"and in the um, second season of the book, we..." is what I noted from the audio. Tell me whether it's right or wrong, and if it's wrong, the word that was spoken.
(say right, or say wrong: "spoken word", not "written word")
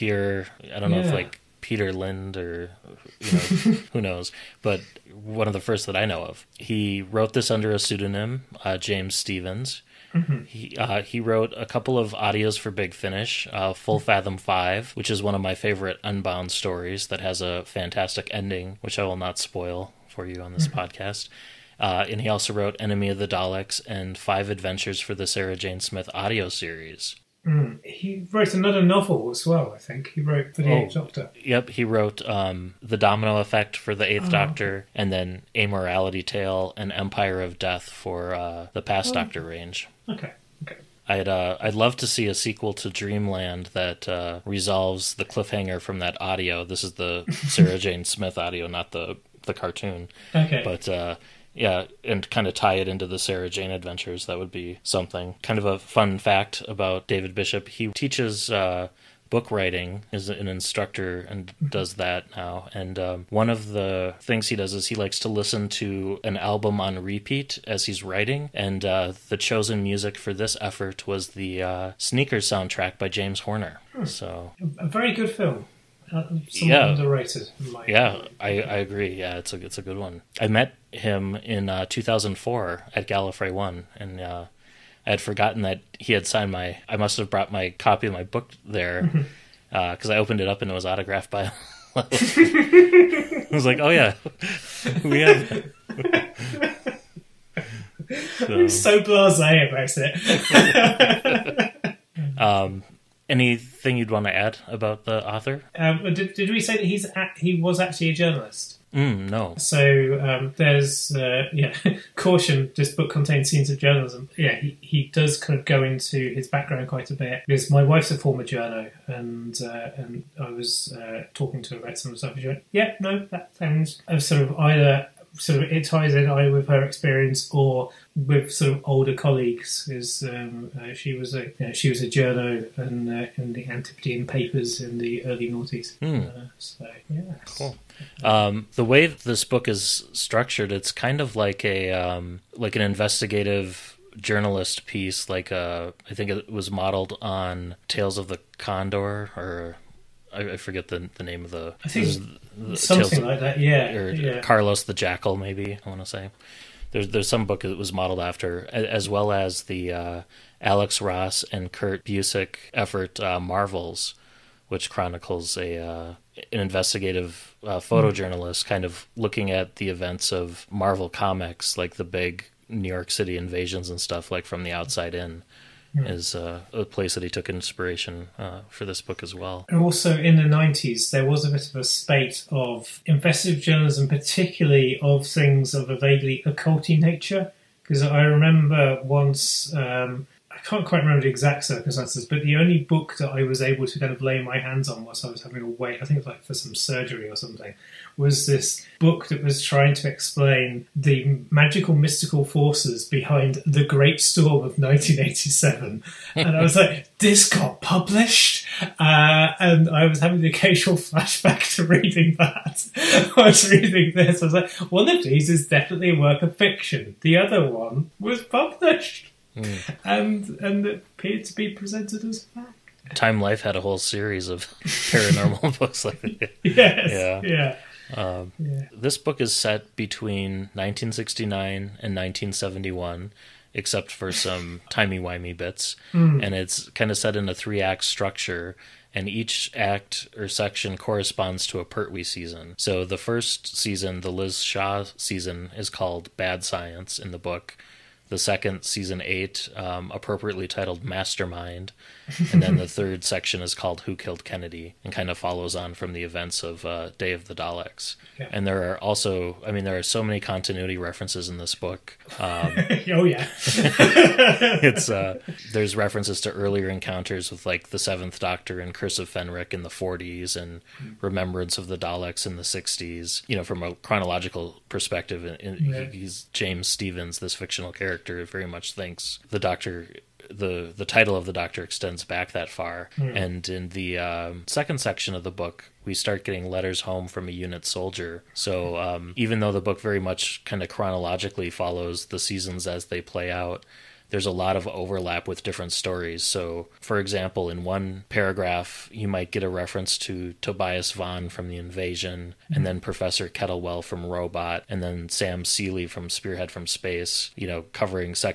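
wrong: "section", not "season".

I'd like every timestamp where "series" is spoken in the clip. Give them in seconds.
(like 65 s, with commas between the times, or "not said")
26 s, 223 s.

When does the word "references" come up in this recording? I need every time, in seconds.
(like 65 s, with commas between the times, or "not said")
260 s, 265 s, 299 s.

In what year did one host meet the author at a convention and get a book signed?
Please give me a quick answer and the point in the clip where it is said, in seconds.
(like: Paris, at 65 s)
2004, at 81 s.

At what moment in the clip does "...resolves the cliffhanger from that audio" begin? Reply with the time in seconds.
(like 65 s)
44 s.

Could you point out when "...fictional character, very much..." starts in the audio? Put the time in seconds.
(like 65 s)
277 s.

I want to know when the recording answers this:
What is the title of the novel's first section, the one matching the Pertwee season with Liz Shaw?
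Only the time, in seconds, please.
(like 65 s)
246 s.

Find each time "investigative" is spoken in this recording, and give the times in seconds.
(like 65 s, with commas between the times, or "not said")
142 s, 166 s, 183 s.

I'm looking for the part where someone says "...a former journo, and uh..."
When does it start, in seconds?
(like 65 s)
118 s.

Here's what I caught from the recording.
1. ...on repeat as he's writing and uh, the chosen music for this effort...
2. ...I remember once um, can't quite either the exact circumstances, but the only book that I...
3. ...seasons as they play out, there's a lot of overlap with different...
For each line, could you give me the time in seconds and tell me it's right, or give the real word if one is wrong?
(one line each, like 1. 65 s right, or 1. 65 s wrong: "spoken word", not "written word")
1. 66 s right
2. 188 s wrong: "remember", not "either"
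3. 292 s right.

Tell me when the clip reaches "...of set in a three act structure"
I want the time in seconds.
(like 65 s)
237 s.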